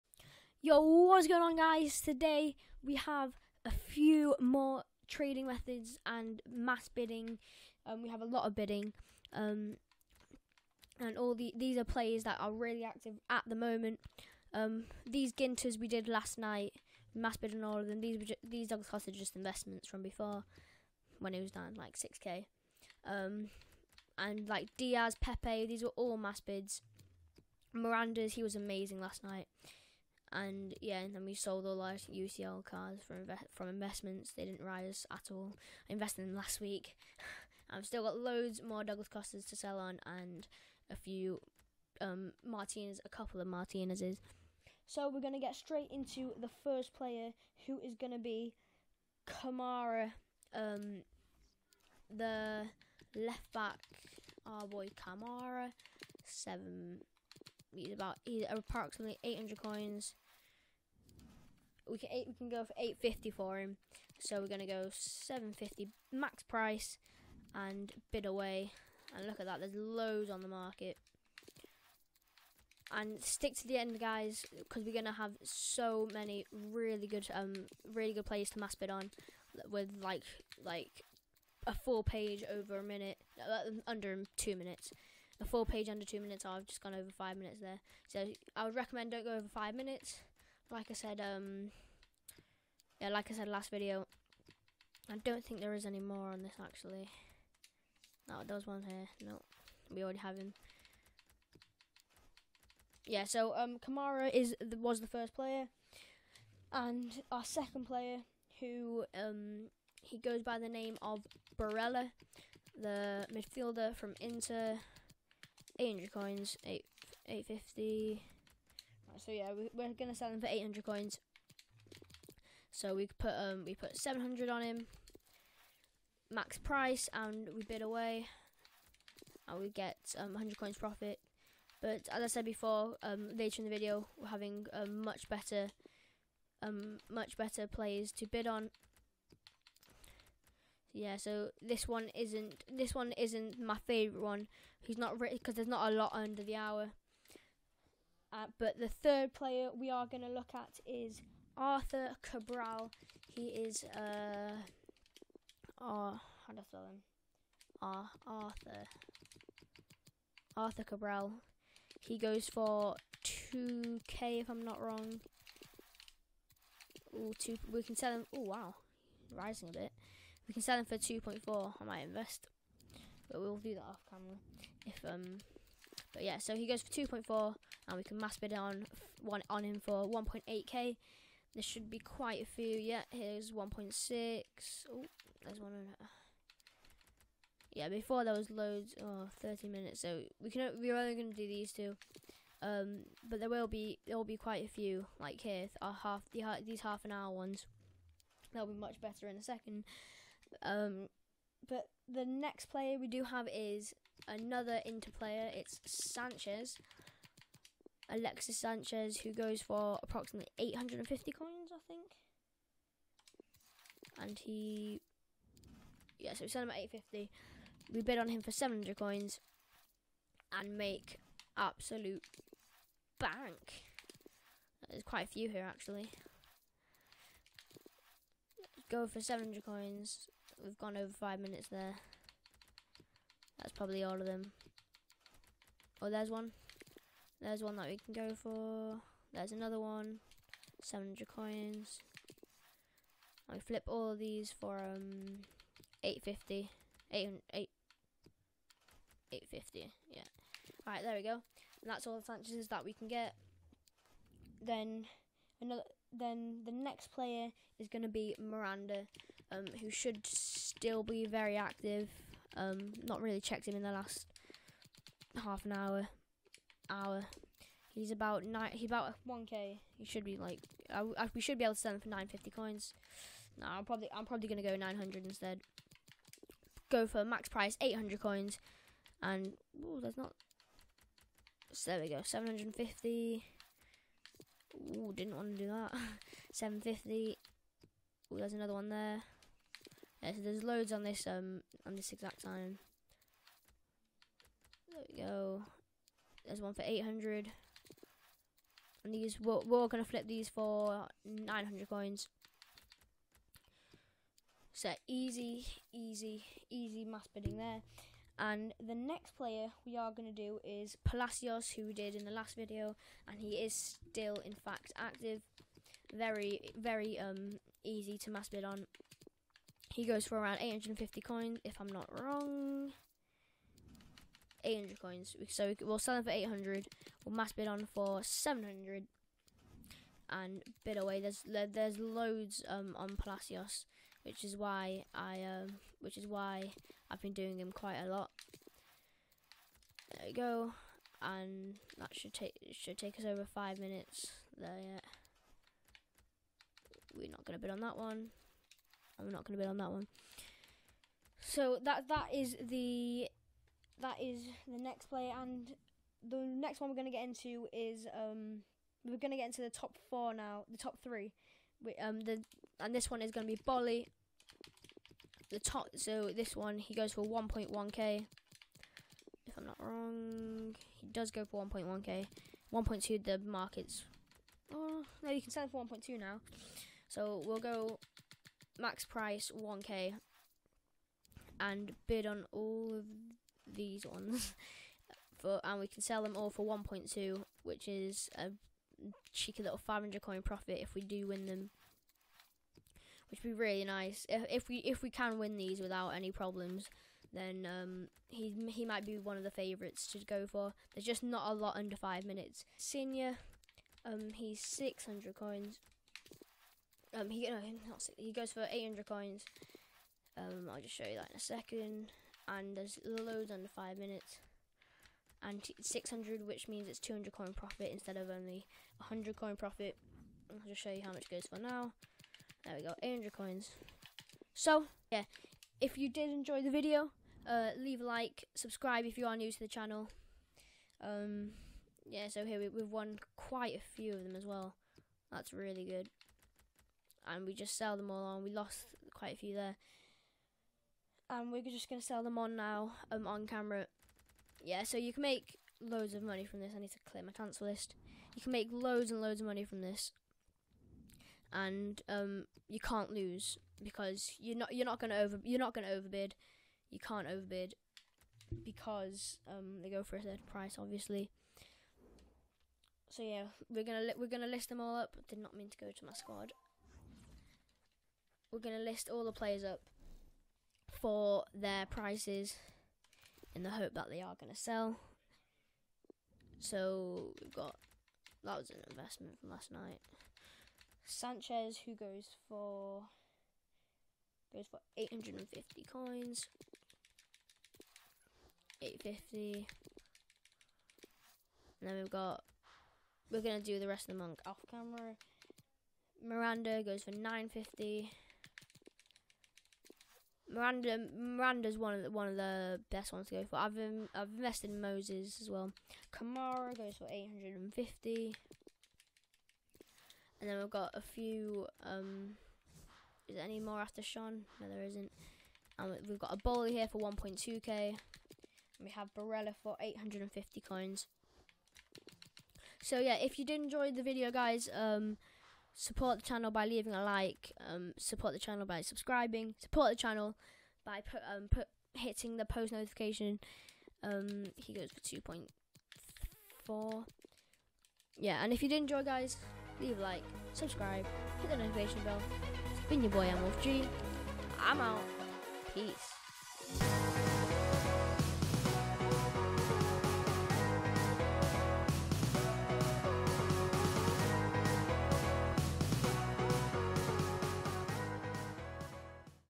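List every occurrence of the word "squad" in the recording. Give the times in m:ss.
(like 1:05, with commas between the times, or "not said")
7:46.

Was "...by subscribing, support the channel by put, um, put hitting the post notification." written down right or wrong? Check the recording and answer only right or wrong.
right.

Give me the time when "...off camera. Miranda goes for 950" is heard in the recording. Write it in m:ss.
8:14.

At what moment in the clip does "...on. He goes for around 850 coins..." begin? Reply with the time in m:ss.
5:18.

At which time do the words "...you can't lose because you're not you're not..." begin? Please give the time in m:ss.
7:32.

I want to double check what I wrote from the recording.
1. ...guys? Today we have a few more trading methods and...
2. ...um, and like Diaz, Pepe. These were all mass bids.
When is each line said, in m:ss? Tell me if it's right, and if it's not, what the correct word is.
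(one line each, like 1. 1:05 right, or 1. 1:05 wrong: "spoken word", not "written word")
1. 0:01 right
2. 0:23 right.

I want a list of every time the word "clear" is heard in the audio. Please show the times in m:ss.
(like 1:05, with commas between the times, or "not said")
7:27.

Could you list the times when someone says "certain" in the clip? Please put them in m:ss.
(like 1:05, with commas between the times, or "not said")
7:40.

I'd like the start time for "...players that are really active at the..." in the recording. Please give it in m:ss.
0:11.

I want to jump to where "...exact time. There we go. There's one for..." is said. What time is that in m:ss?
4:52.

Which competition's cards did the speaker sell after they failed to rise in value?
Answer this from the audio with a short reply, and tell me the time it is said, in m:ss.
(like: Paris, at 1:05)
UCL, at 0:32.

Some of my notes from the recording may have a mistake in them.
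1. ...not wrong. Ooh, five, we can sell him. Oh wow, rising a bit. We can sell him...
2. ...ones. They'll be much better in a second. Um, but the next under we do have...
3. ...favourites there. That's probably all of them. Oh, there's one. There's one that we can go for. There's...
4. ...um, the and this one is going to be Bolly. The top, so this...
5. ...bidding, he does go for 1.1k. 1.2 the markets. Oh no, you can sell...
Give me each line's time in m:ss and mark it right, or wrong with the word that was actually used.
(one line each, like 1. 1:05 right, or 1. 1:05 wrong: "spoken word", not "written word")
1. 2:44 wrong: "two", not "five"
2. 3:17 wrong: "player", not "under"
3. 3:51 wrong: "minutes", not "favourites"
4. 6:01 right
5. 6:09 wrong: "wrong", not "bidding".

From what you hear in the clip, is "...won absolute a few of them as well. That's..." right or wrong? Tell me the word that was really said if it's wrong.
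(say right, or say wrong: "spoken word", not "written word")
wrong: "quite", not "absolute".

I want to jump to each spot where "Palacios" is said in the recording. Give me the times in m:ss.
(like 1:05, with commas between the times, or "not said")
5:11, 5:33.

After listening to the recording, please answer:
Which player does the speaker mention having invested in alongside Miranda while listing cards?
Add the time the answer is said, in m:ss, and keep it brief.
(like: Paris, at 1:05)
Moses, at 8:24.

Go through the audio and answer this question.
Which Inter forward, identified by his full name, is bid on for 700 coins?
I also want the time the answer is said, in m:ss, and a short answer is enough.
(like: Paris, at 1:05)
Alexis Sanchez, at 3:28.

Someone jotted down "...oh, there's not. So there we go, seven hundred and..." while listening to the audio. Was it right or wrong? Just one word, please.
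right.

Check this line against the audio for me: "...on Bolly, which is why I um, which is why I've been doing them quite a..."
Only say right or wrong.
wrong.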